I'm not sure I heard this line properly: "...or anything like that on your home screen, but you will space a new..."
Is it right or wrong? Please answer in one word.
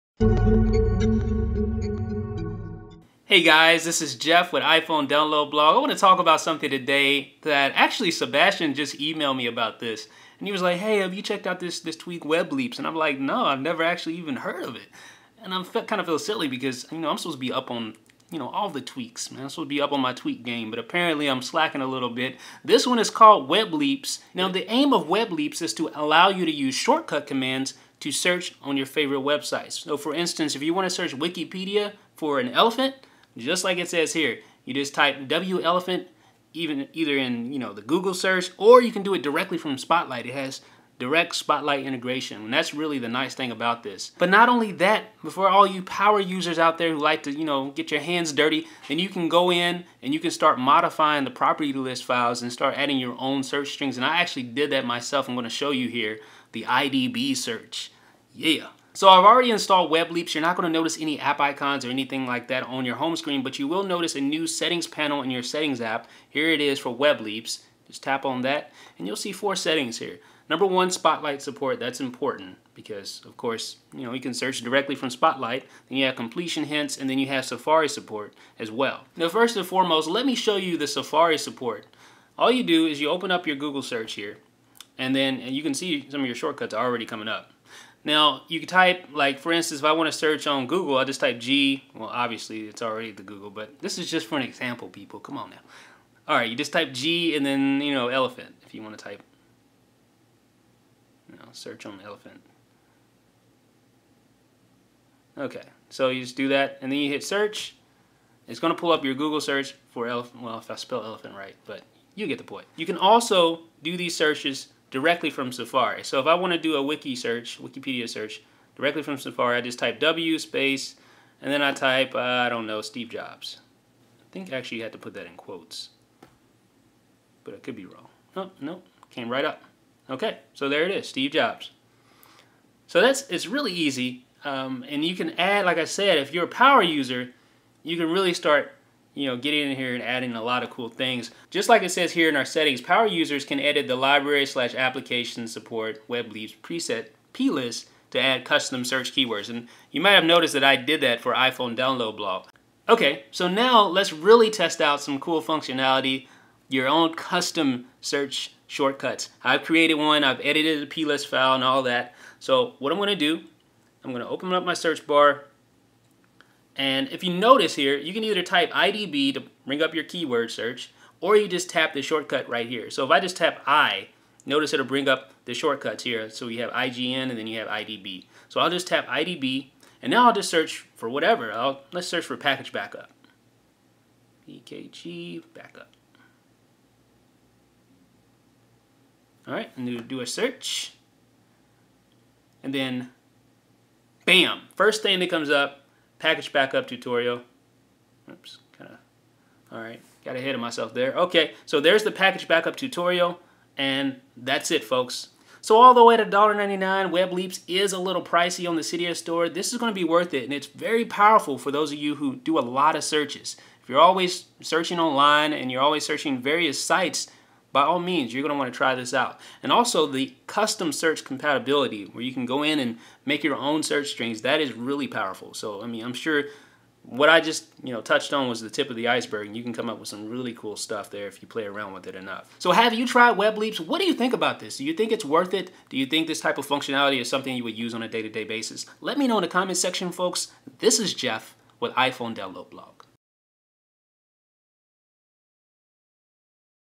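wrong.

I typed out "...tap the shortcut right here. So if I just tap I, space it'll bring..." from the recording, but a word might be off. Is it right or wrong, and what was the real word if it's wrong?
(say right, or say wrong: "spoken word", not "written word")
wrong: "notice", not "space".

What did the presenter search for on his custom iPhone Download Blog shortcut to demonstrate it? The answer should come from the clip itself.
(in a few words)
PKG backup.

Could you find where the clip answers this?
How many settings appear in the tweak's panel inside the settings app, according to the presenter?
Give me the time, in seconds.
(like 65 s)
69 s.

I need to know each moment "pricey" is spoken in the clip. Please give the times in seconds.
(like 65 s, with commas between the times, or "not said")
208 s.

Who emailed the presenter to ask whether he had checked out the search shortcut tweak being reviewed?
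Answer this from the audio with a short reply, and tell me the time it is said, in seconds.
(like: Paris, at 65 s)
Sebastian, at 8 s.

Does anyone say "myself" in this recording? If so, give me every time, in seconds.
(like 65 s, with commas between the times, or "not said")
54 s, 200 s.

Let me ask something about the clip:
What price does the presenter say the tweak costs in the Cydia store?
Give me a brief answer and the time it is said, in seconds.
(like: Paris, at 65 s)
$1.99, at 206 s.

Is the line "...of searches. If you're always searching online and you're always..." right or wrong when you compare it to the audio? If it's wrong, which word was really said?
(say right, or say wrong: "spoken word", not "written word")
right.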